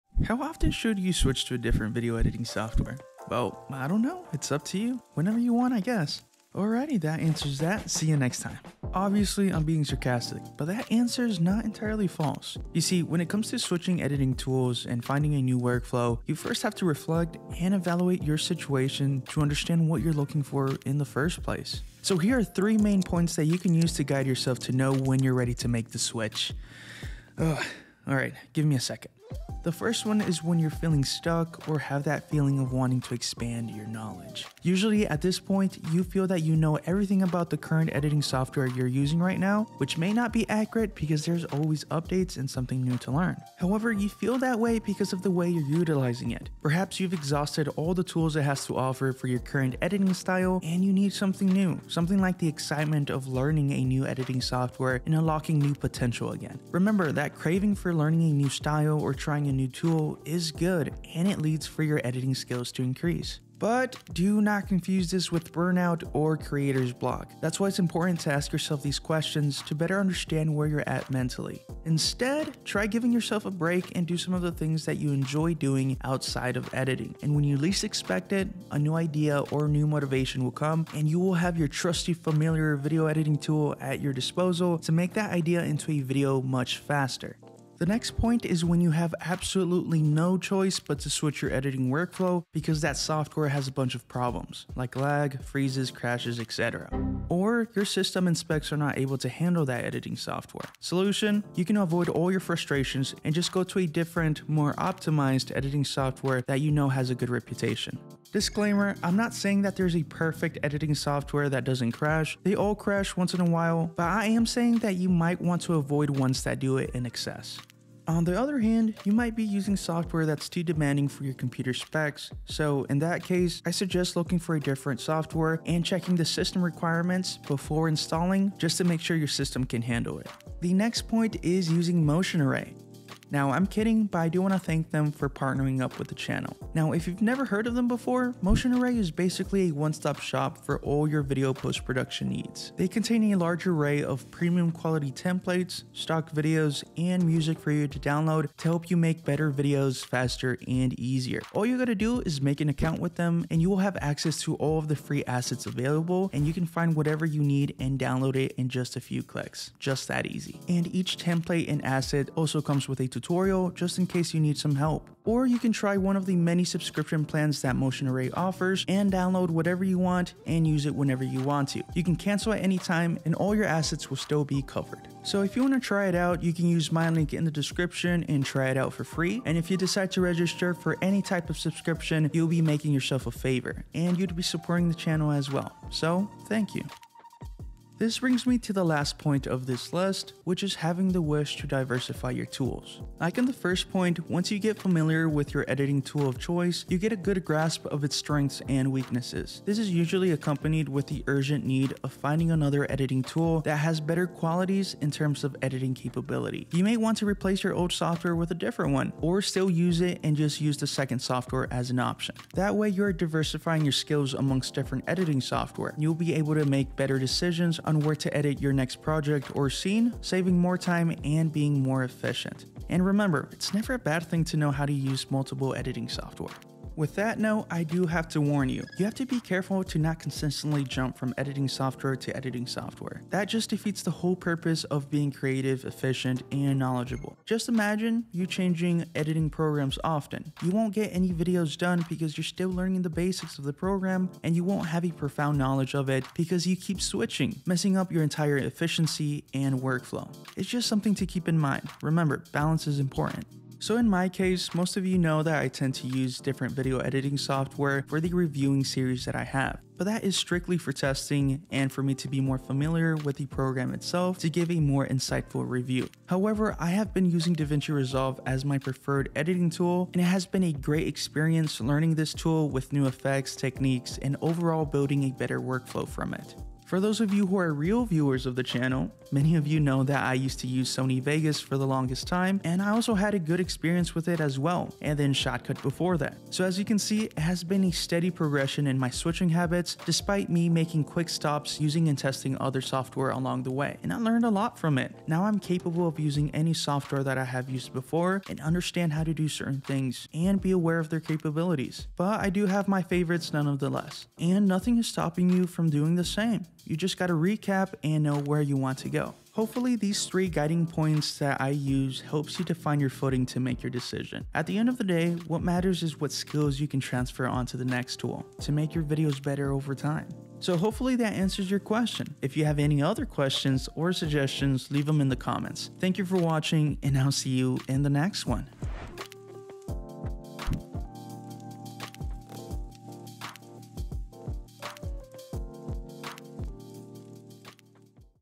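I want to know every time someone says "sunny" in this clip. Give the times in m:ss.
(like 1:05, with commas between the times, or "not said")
not said.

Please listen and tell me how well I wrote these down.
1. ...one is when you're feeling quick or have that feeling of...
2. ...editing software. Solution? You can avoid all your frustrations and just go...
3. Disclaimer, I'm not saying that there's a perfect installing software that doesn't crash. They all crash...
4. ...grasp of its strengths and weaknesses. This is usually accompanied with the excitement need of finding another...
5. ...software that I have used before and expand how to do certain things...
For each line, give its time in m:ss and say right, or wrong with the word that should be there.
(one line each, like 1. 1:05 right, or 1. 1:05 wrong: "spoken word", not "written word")
1. 0:30 wrong: "stuck", not "quick"
2. 1:39 right
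3. 1:48 wrong: "editing", not "installing"
4. 3:17 wrong: "urgent", not "excitement"
5. 4:56 wrong: "understand", not "expand".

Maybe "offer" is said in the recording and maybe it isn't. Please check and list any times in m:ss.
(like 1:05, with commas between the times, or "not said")
0:48, 2:48.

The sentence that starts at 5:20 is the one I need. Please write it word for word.
So hopefully that answers your question.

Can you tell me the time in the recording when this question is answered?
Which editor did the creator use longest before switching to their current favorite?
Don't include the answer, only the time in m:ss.
4:40.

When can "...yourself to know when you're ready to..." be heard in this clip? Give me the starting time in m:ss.
0:24.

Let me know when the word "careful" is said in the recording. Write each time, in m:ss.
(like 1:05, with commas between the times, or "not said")
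3:49.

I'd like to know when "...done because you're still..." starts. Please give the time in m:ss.
4:01.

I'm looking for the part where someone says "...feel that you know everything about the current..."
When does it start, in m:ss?
0:36.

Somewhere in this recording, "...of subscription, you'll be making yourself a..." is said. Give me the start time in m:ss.
3:01.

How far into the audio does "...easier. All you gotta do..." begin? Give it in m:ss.
2:30.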